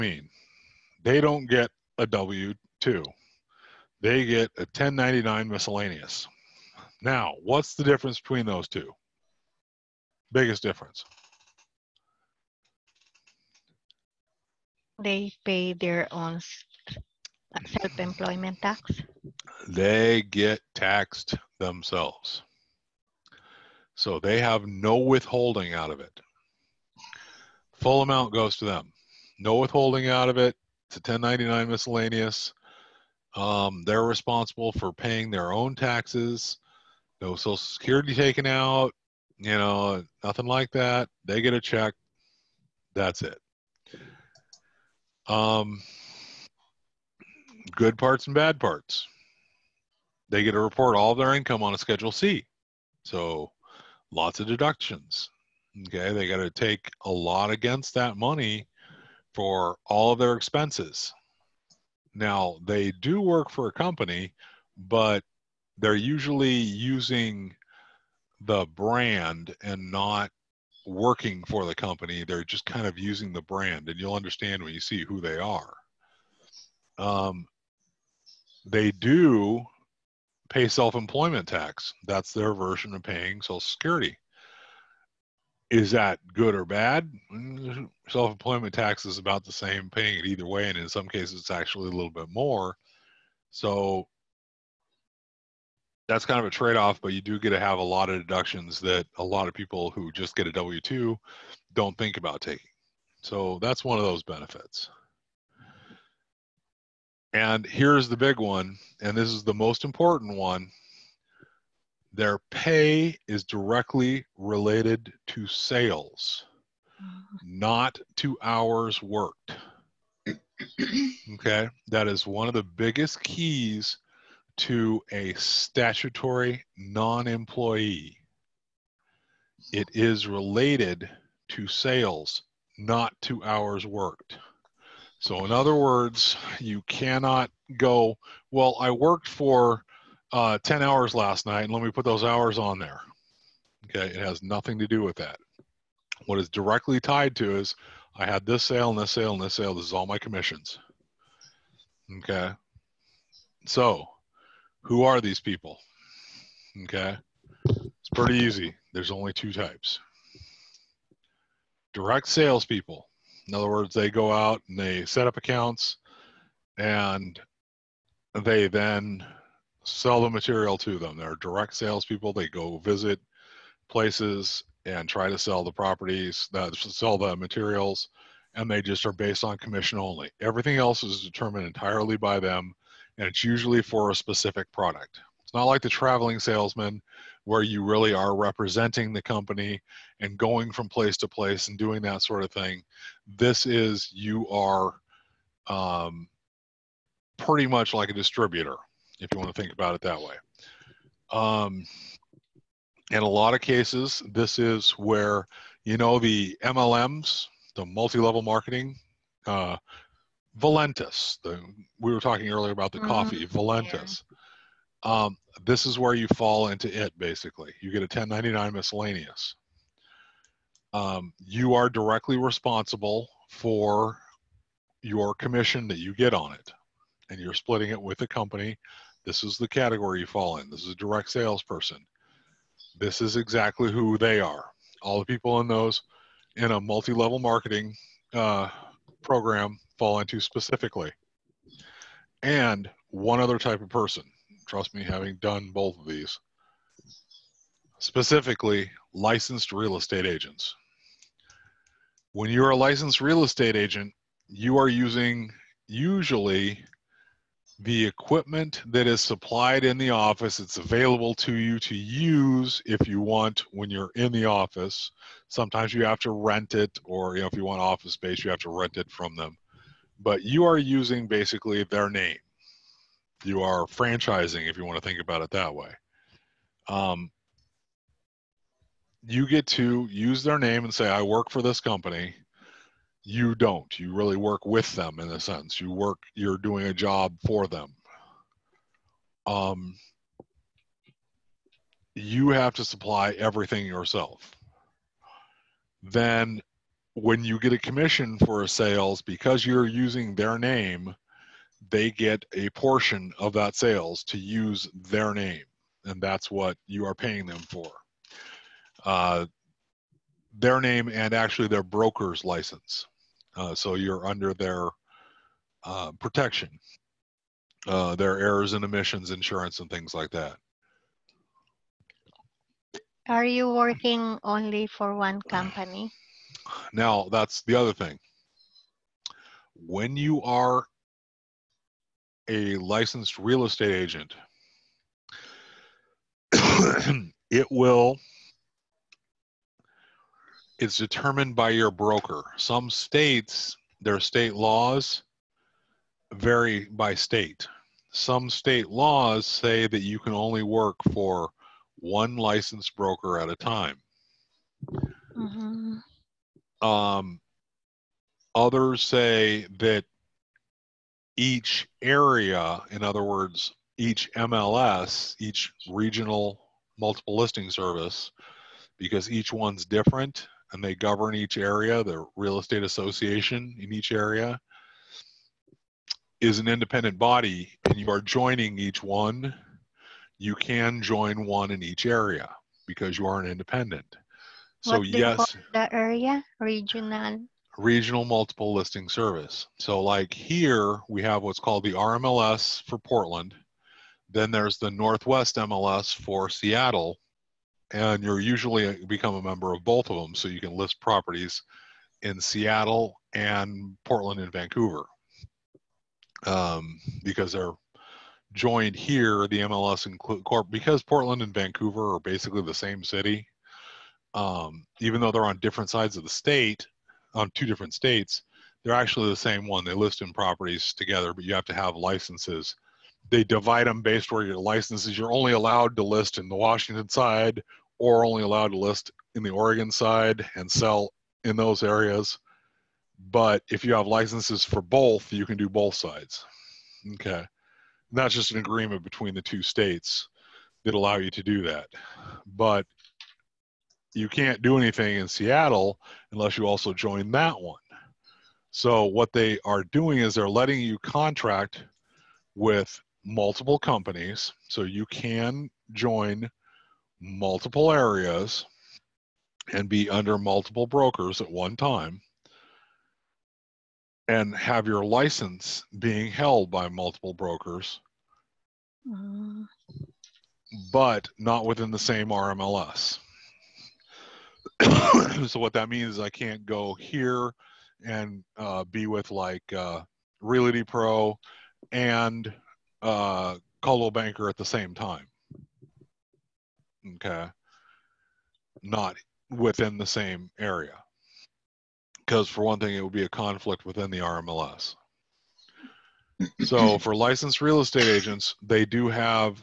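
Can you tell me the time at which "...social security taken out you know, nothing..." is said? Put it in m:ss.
0:37.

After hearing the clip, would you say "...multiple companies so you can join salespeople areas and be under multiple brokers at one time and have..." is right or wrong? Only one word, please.
wrong.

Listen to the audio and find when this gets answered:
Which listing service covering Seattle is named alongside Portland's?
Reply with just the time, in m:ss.
6:34.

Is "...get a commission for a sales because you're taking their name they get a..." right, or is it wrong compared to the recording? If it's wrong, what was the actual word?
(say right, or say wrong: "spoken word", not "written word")
wrong: "using", not "taking".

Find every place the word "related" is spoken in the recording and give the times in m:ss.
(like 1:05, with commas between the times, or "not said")
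1:54, 2:10.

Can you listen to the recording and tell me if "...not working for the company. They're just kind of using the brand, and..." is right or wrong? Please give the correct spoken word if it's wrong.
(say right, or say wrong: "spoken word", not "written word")
right.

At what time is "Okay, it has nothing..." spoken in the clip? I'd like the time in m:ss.
2:23.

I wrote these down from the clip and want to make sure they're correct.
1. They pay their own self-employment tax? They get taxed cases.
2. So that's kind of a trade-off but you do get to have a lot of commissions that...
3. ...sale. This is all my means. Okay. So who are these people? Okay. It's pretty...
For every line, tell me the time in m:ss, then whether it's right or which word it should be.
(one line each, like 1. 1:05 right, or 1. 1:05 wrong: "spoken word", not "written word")
1. 0:15 wrong: "themselves", not "cases"
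2. 1:33 wrong: "deductions", not "commissions"
3. 2:29 wrong: "commissions", not "means".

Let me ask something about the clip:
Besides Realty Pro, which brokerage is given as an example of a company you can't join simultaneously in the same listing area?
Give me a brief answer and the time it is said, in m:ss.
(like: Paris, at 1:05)
Coldwell Banker, at 8:03.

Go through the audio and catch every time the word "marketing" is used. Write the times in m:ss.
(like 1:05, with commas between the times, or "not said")
3:28, 3:57.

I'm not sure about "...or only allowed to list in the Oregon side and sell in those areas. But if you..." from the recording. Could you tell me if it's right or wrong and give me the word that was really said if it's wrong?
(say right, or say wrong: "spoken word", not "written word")
right.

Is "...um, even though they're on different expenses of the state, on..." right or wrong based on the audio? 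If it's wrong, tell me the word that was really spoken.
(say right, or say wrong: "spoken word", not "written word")
wrong: "sides", not "expenses".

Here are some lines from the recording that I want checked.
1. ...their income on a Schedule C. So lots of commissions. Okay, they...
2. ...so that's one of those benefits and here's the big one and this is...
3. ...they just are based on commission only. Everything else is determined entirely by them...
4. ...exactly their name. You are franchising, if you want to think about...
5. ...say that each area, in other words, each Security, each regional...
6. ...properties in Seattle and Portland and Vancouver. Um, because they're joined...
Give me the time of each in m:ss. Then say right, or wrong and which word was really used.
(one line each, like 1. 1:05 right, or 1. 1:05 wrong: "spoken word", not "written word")
1. 0:51 wrong: "deductions", not "commissions"
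2. 1:43 right
3. 2:58 right
4. 4:31 wrong: "basically", not "exactly"
5. 5:59 wrong: "MLS", not "Security"
6. 6:40 right.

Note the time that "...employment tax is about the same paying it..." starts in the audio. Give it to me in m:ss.
1:28.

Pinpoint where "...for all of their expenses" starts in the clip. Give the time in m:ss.
0:59.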